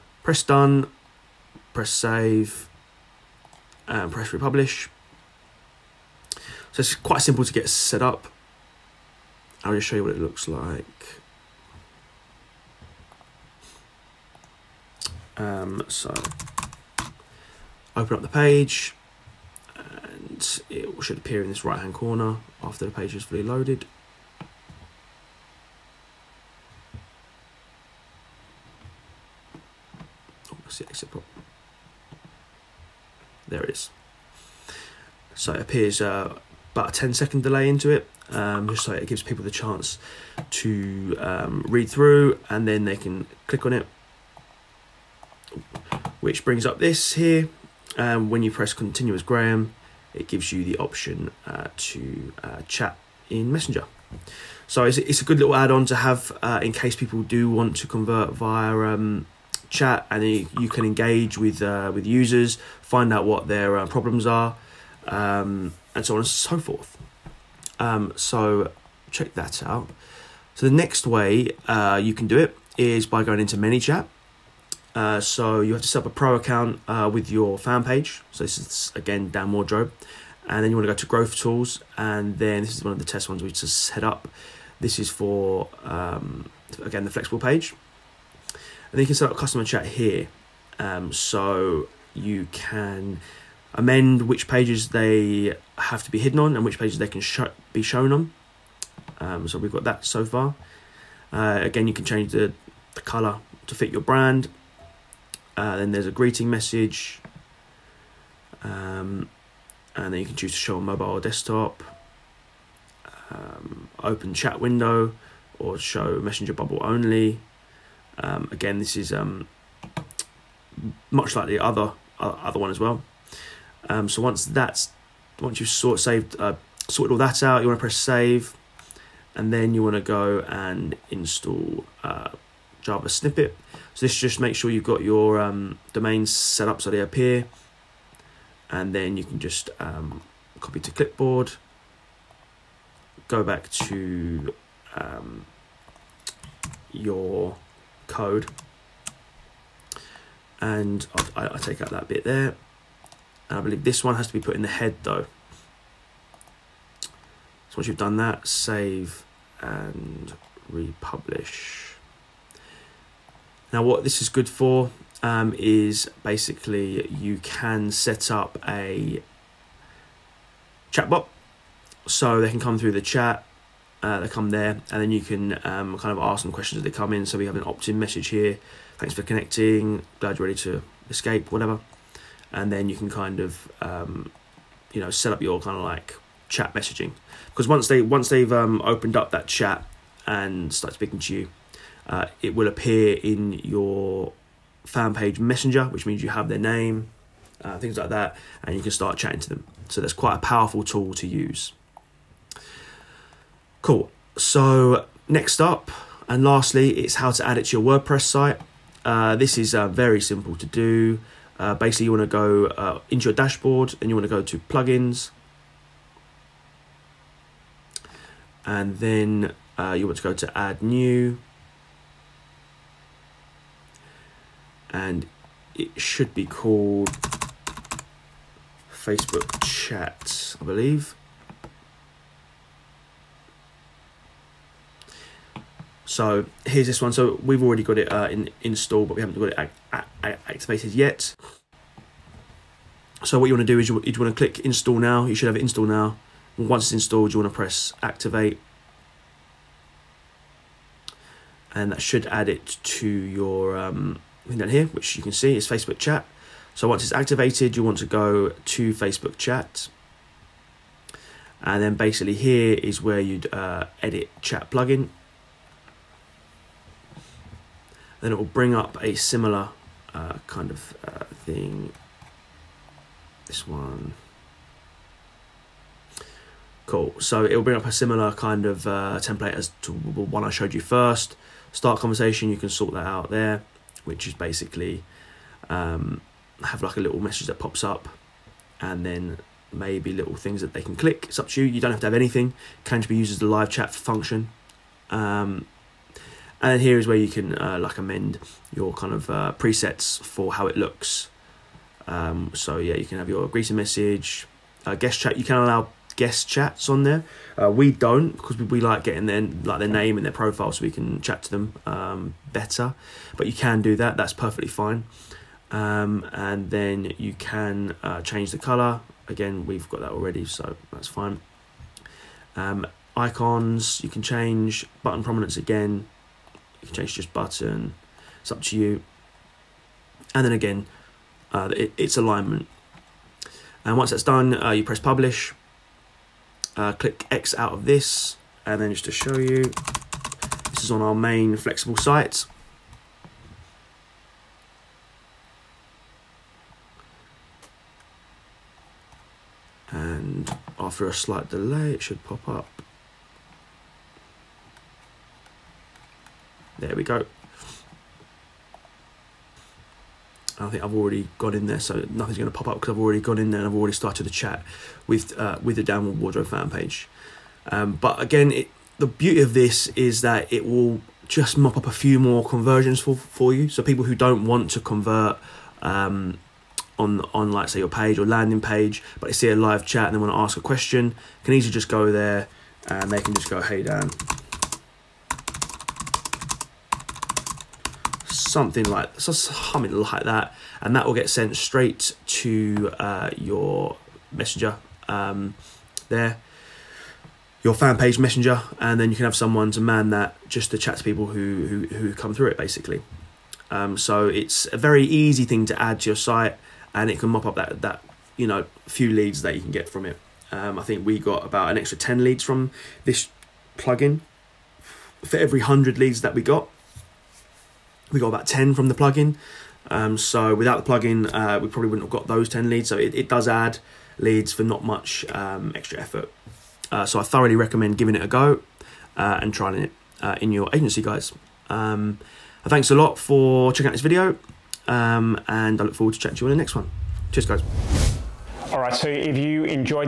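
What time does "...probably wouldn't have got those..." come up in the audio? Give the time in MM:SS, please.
07:01.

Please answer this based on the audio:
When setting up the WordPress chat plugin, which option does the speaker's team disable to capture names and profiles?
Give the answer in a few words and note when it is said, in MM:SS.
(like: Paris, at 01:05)
guest chats, at 05:06.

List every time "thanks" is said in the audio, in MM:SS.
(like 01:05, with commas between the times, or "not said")
02:58, 07:12.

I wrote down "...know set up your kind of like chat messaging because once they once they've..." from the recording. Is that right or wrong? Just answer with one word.
right.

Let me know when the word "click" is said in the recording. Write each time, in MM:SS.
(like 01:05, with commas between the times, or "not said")
00:43, 04:04, 04:50, 05:36.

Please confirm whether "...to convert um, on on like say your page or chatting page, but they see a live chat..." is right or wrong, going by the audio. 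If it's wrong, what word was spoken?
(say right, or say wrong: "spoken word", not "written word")
wrong: "landing", not "chatting".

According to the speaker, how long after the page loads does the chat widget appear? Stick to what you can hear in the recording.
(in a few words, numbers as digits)
10 second delay.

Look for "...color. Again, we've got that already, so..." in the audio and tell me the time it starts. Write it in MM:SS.
05:18.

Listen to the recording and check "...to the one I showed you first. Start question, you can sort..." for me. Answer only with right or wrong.
wrong.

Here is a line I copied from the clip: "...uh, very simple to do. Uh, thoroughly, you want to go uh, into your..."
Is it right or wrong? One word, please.
wrong.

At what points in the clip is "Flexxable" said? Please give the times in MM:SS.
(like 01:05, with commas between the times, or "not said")
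01:27, 05:41.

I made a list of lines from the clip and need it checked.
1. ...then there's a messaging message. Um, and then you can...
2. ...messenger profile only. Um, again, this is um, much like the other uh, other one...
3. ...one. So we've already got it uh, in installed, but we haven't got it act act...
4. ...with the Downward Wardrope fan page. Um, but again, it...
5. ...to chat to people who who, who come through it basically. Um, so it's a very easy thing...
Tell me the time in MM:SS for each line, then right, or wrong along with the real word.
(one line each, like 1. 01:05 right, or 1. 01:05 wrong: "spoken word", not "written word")
1. 01:45 wrong: "greeting", not "messaging"
2. 01:56 wrong: "bubble", not "profile"
3. 03:57 right
4. 06:05 right
5. 06:40 right.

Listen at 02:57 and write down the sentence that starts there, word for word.
So we have an opt-in message here.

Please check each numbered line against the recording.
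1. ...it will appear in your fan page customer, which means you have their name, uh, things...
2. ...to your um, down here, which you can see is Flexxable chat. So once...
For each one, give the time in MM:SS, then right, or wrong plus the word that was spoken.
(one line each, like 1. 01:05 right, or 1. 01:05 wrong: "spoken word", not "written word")
1. 03:12 wrong: "messenger", not "customer"
2. 04:12 wrong: "Facebook", not "Flexxable".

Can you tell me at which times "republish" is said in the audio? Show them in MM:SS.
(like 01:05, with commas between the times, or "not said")
00:04, 02:40.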